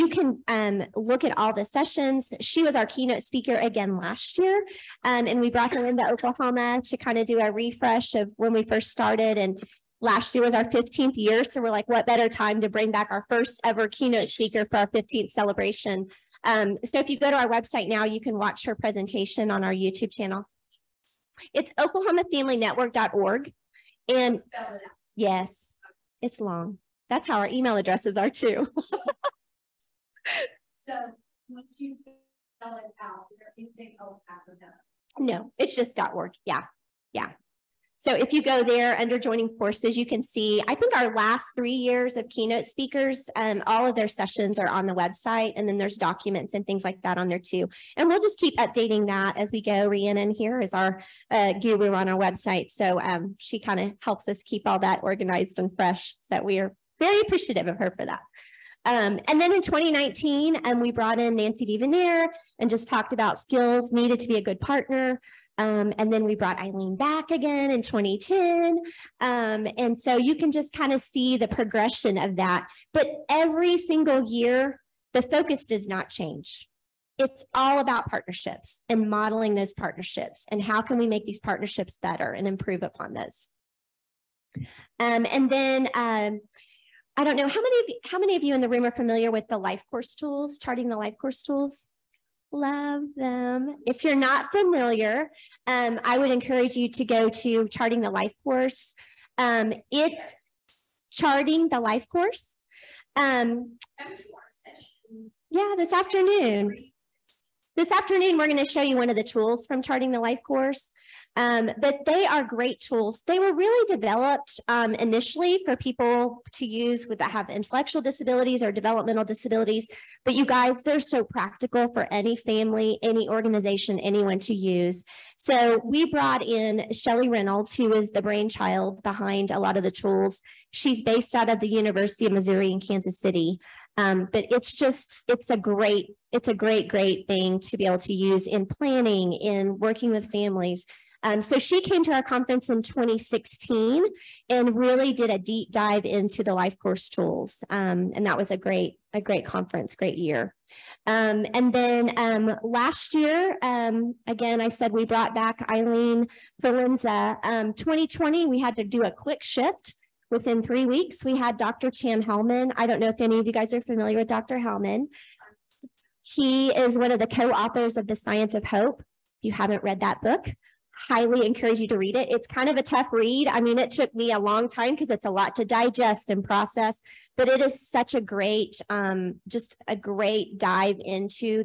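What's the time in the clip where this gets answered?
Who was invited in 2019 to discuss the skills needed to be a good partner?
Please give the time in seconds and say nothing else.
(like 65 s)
61 s.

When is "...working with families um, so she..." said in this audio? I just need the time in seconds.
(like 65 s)
139 s.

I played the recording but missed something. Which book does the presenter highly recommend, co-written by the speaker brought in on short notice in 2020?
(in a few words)
The Science of Hope.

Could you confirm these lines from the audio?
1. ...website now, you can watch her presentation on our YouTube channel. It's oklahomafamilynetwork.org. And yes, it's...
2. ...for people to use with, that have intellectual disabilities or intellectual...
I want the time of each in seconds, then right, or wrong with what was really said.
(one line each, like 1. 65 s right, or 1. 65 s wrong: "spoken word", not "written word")
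1. 17 s right
2. 115 s wrong: "developmental", not "intellectual".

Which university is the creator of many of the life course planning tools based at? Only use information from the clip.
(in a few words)
University of Missouri in Kansas City.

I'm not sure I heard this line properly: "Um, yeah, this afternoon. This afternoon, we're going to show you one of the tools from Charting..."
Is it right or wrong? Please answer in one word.
right.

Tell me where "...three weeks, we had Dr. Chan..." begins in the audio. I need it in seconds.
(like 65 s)
160 s.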